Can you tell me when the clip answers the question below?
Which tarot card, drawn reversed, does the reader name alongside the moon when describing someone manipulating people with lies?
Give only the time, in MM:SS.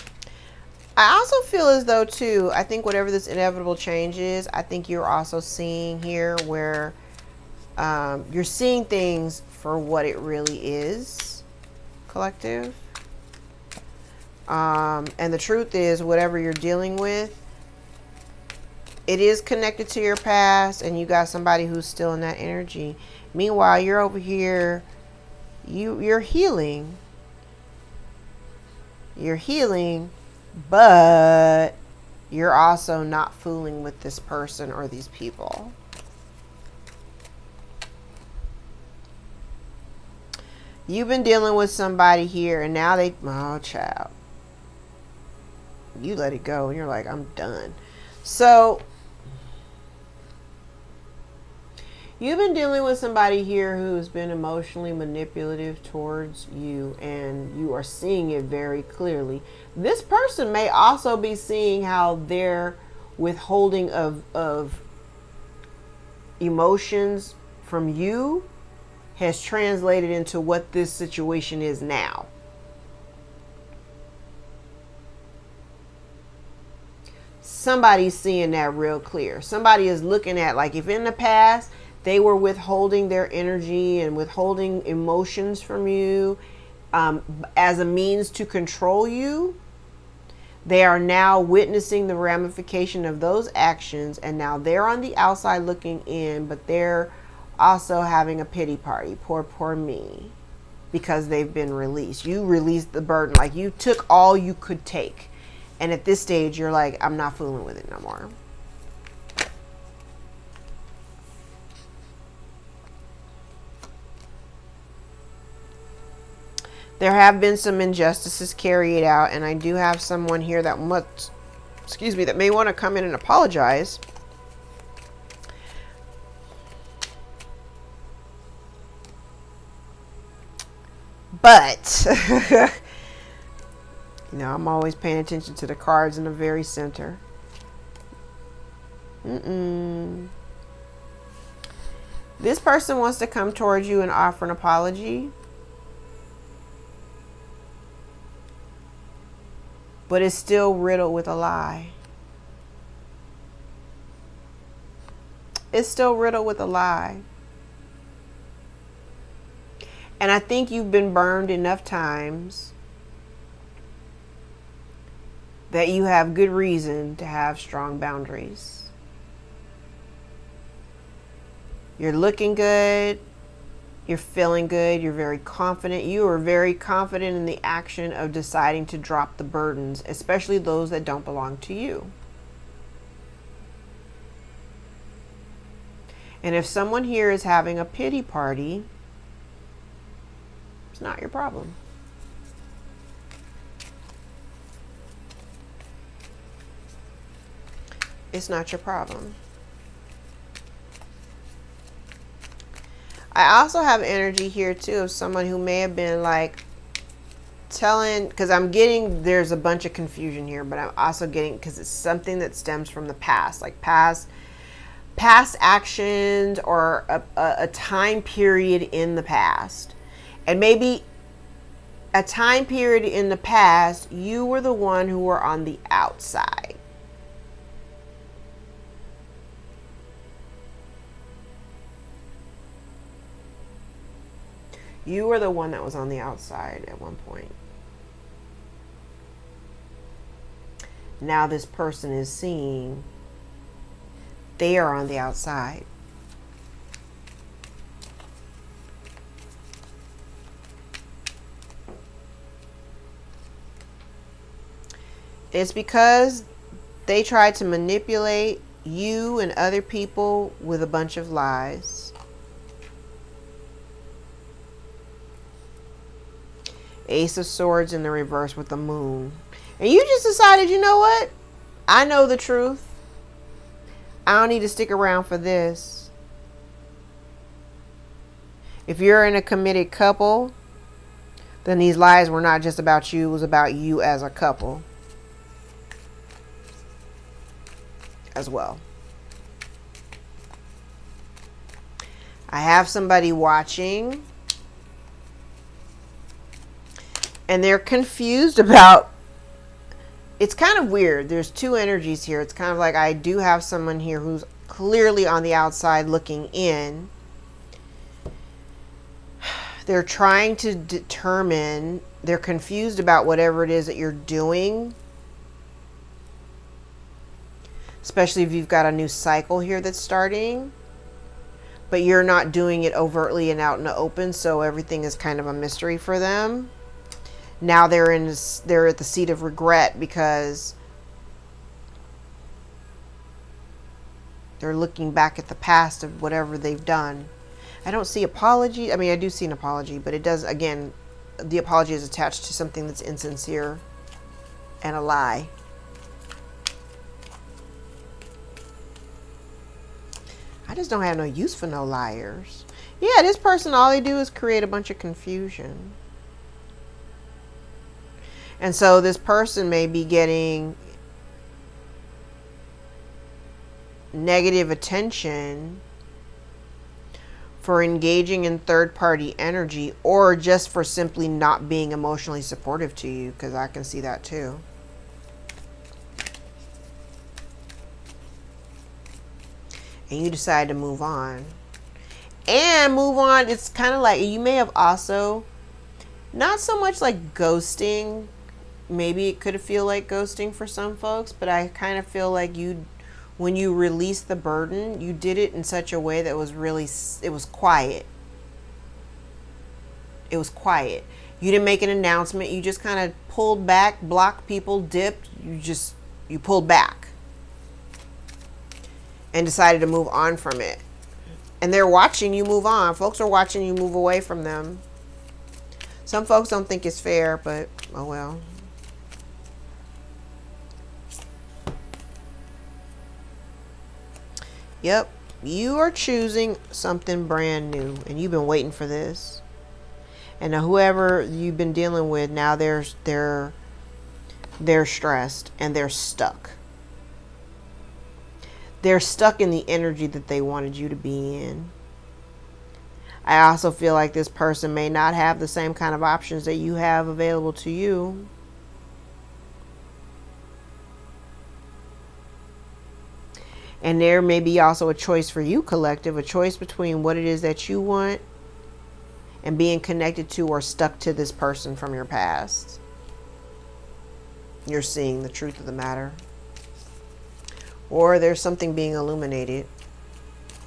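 04:27.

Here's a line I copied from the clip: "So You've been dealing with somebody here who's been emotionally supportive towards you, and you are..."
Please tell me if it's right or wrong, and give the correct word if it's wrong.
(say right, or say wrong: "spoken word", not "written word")
wrong: "manipulative", not "supportive".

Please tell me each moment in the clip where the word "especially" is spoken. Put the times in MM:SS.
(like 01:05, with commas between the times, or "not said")
03:00, 05:18.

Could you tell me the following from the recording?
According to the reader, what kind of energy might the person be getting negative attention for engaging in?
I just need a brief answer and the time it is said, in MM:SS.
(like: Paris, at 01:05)
third party energy, at 06:08.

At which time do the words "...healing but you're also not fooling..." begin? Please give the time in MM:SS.
00:29.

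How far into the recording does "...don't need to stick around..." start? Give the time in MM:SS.
04:34.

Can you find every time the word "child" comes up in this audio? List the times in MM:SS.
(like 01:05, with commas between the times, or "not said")
00:43.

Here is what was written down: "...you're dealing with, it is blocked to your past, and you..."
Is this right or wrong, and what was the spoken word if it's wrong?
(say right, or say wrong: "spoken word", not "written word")
wrong: "connected", not "blocked".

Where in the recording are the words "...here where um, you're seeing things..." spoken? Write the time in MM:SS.
00:06.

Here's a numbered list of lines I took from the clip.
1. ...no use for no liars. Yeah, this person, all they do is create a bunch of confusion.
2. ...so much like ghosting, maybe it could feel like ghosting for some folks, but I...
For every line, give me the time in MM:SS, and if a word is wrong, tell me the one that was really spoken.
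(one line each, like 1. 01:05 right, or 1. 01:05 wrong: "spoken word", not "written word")
1. 05:51 right
2. 06:26 right.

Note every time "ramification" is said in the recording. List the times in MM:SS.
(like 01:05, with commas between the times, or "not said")
01:32.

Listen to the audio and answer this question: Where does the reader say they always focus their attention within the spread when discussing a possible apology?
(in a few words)
the very center.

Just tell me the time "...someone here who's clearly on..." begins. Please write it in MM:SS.
05:03.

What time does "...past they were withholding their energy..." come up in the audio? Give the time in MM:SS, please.
01:21.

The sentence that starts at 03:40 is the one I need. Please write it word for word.
And maybe a time period in the past, you were the one who were on the outside.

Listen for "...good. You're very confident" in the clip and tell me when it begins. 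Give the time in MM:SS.
02:54.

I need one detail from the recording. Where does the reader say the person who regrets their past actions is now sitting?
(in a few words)
the seat of regret.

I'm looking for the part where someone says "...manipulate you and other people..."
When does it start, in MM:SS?
04:17.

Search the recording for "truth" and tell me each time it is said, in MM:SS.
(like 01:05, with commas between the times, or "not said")
00:15, 04:32, 07:45.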